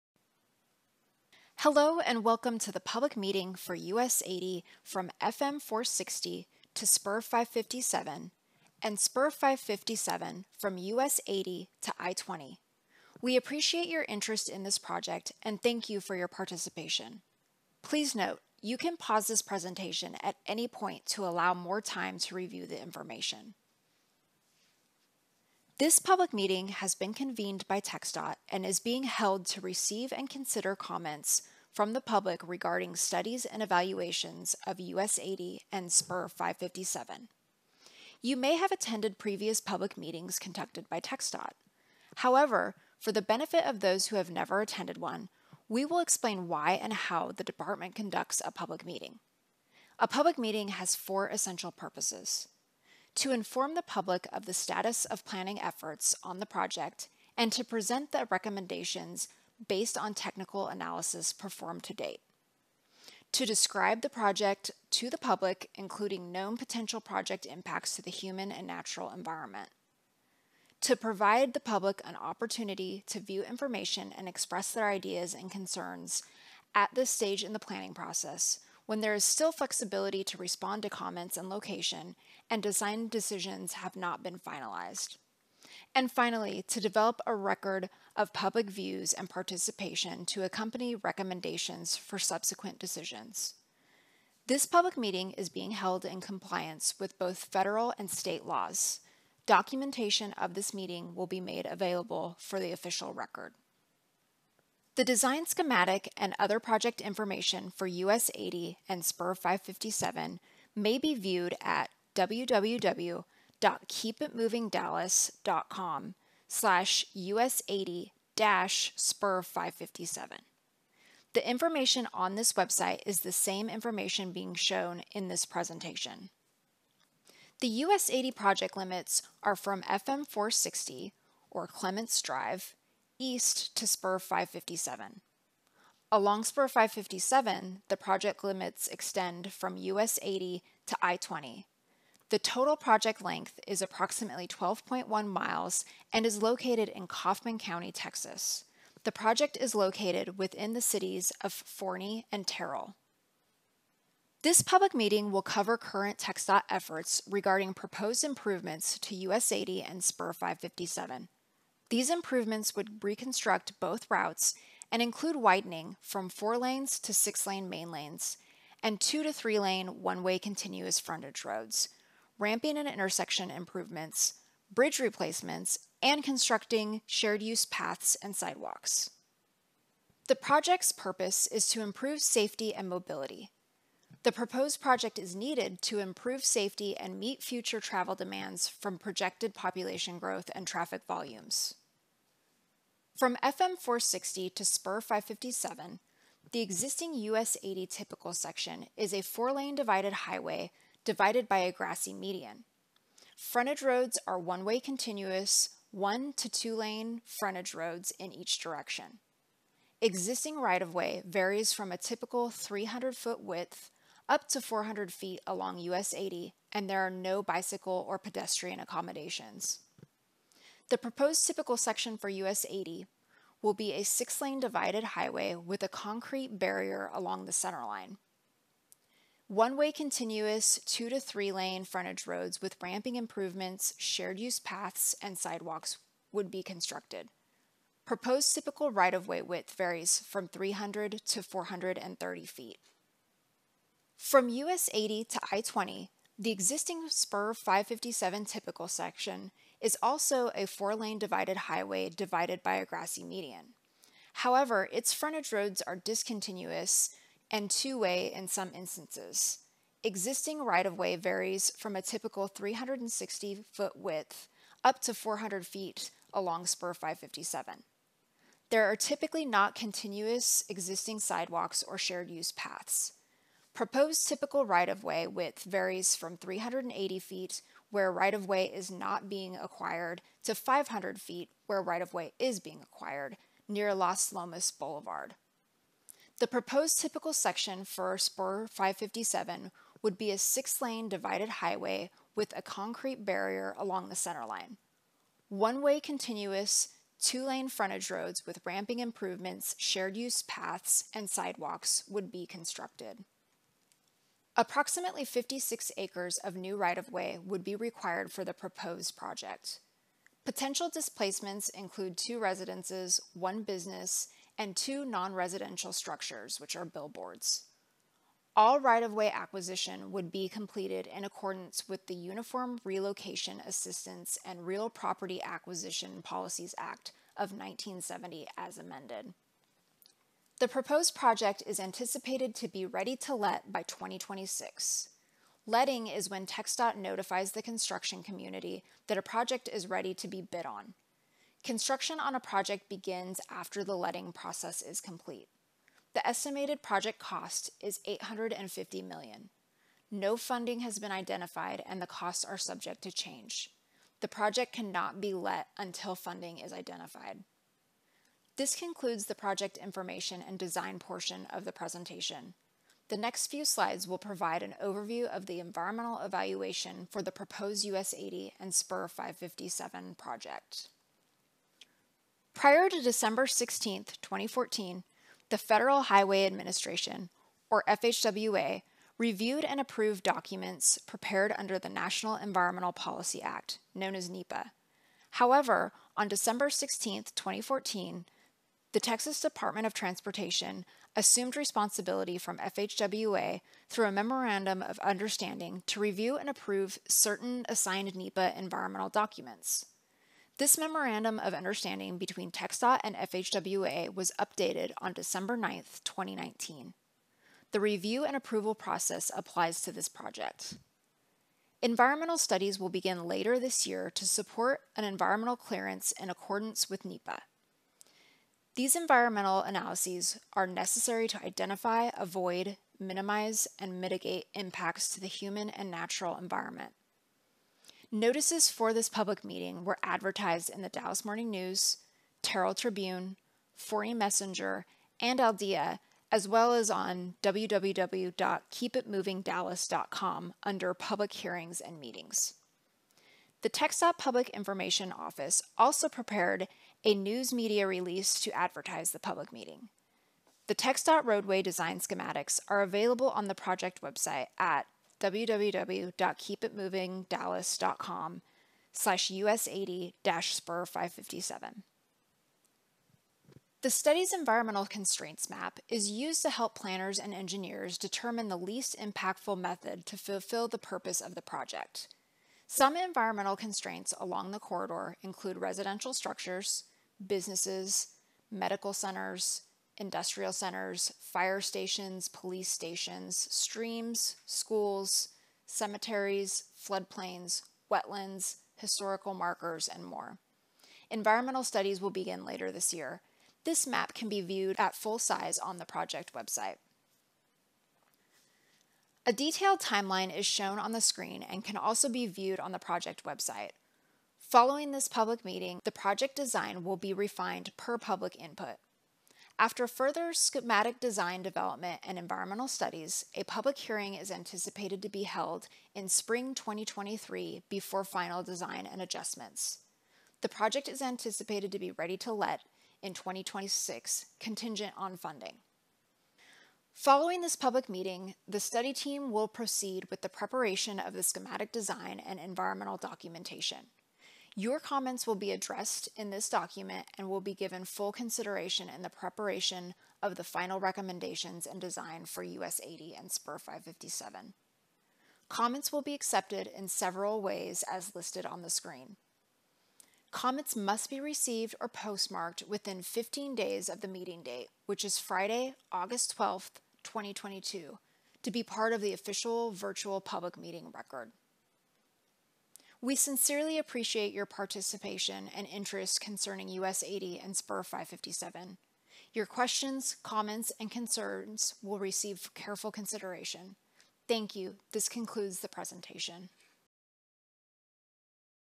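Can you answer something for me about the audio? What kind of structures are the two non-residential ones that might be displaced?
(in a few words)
billboards.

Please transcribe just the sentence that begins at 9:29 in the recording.
Your questions, comments, and concerns will receive careful consideration.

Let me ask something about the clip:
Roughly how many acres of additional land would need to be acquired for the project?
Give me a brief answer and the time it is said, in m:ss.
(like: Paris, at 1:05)
56 acres, at 5:05.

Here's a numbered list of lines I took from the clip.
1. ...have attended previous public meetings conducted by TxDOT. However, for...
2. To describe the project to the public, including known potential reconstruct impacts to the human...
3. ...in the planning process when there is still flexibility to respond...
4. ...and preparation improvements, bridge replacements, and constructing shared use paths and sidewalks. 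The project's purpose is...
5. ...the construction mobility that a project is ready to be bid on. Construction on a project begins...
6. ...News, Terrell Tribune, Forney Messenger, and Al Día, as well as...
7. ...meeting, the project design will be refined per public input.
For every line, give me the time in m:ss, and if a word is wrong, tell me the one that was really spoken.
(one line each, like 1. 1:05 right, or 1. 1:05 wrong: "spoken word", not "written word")
1. 0:38 right
2. 1:03 wrong: "project", not "reconstruct"
3. 1:17 right
4. 2:52 wrong: "intersection", not "preparation"
5. 5:37 wrong: "community", not "mobility"
6. 7:11 right
7. 8:25 right.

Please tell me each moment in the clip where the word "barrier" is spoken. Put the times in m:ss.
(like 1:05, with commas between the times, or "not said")
3:46, 4:53.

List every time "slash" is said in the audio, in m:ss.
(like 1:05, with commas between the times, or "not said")
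1:56, 7:38.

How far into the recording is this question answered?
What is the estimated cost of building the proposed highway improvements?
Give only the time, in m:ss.
5:48.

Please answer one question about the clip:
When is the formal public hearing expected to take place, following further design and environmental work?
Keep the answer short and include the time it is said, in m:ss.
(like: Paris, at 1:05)
spring 2023, at 8:36.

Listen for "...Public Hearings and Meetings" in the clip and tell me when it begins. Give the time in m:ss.
7:20.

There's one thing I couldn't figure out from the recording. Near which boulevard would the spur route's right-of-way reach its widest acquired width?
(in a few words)
Las Lomas Boulevard.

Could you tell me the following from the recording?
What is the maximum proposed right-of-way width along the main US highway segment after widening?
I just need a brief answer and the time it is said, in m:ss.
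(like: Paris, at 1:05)
430 feet, at 4:01.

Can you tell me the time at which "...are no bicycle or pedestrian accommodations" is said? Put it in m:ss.
3:37.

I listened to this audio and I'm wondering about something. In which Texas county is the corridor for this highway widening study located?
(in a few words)
Kaufman County.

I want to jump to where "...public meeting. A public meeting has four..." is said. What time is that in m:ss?
0:48.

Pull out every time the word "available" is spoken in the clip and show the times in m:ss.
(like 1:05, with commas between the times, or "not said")
1:41, 7:32.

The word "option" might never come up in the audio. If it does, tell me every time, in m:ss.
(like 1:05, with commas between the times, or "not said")
not said.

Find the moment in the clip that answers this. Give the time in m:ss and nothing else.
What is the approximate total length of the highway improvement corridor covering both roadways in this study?
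2:24.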